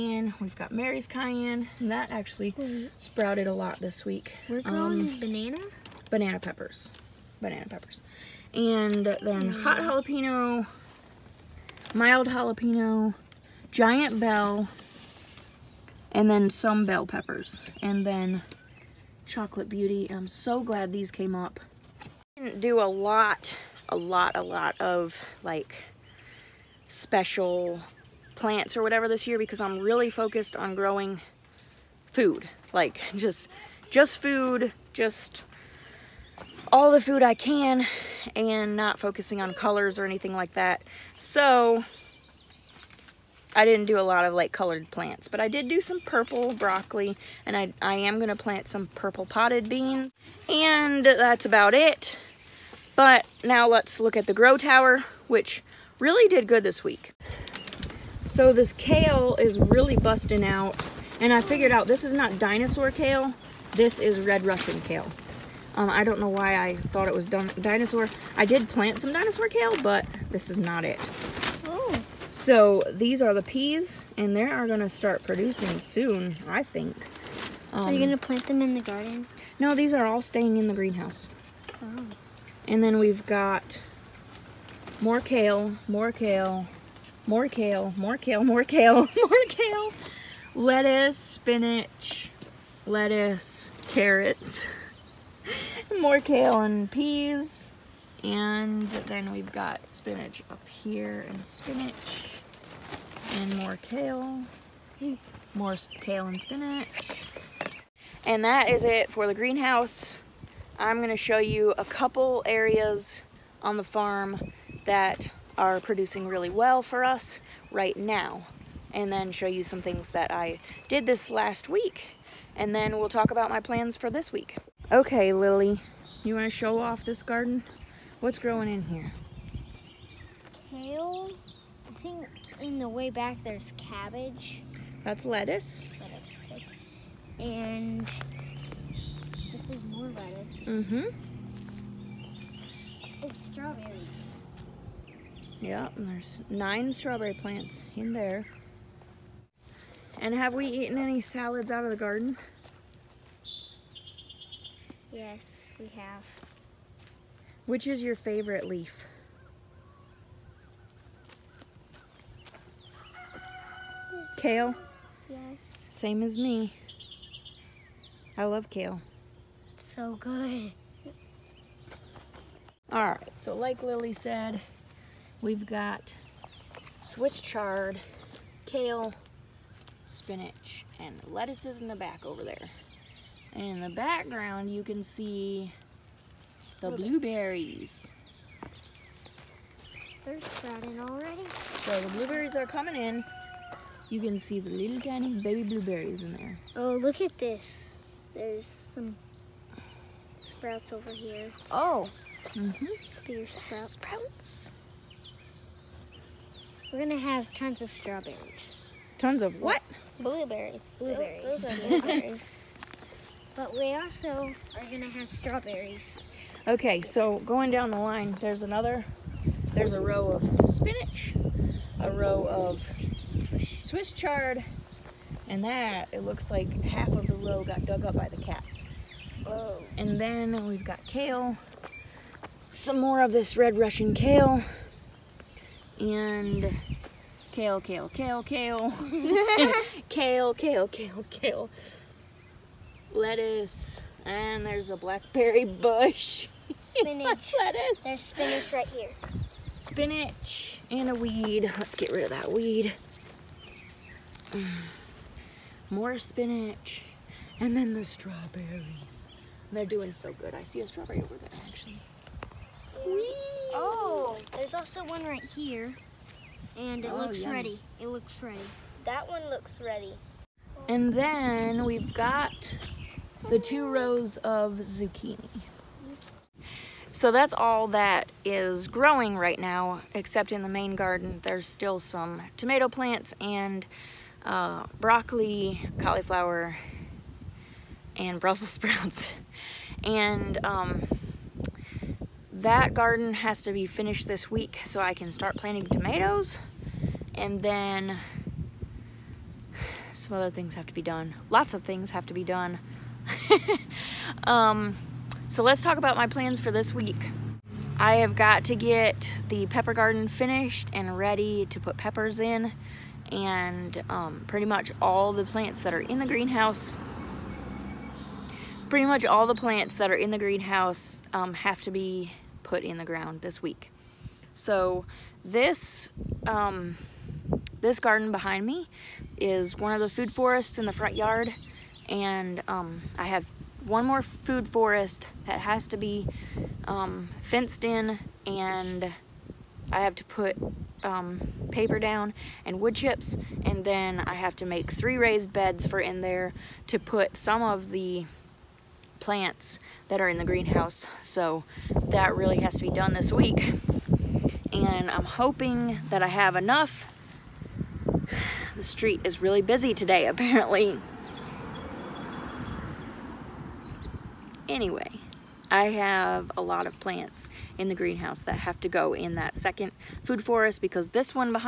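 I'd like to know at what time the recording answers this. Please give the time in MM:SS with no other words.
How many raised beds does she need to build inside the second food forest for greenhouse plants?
05:44.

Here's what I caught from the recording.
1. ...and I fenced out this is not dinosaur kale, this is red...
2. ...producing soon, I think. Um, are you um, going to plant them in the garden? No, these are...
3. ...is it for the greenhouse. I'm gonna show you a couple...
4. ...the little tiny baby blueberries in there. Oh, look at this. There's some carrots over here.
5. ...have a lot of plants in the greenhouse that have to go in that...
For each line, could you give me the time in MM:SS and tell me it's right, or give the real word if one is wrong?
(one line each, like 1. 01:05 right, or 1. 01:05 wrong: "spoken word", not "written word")
1. 01:01 wrong: "figured", not "fenced"
2. 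01:15 right
3. 01:48 right
4. 03:14 wrong: "sprouts", not "carrots"
5. 06:05 right.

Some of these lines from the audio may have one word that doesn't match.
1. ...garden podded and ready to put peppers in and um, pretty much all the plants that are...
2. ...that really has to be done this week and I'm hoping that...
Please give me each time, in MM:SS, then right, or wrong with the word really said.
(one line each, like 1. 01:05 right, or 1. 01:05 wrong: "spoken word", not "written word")
1. 05:09 wrong: "finished", not "podded"
2. 05:52 right.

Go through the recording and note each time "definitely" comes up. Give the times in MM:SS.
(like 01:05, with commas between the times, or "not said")
not said.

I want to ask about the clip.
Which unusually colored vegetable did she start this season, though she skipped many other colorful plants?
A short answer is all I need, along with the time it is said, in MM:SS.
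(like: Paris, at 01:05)
purple broccoli, at 00:46.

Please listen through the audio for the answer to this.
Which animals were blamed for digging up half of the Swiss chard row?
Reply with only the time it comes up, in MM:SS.
03:48.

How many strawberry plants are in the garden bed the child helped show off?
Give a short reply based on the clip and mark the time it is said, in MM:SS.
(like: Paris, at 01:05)
9, at 02:26.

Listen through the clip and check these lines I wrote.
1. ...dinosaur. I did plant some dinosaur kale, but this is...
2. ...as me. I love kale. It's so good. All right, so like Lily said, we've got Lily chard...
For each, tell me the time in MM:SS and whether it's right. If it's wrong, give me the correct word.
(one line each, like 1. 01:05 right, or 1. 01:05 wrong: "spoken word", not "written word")
1. 01:07 right
2. 02:46 wrong: "Swiss", not "Lily".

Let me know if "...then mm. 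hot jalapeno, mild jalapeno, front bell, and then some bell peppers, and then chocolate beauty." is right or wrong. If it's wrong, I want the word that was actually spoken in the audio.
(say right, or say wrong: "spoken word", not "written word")
wrong: "giant", not "front".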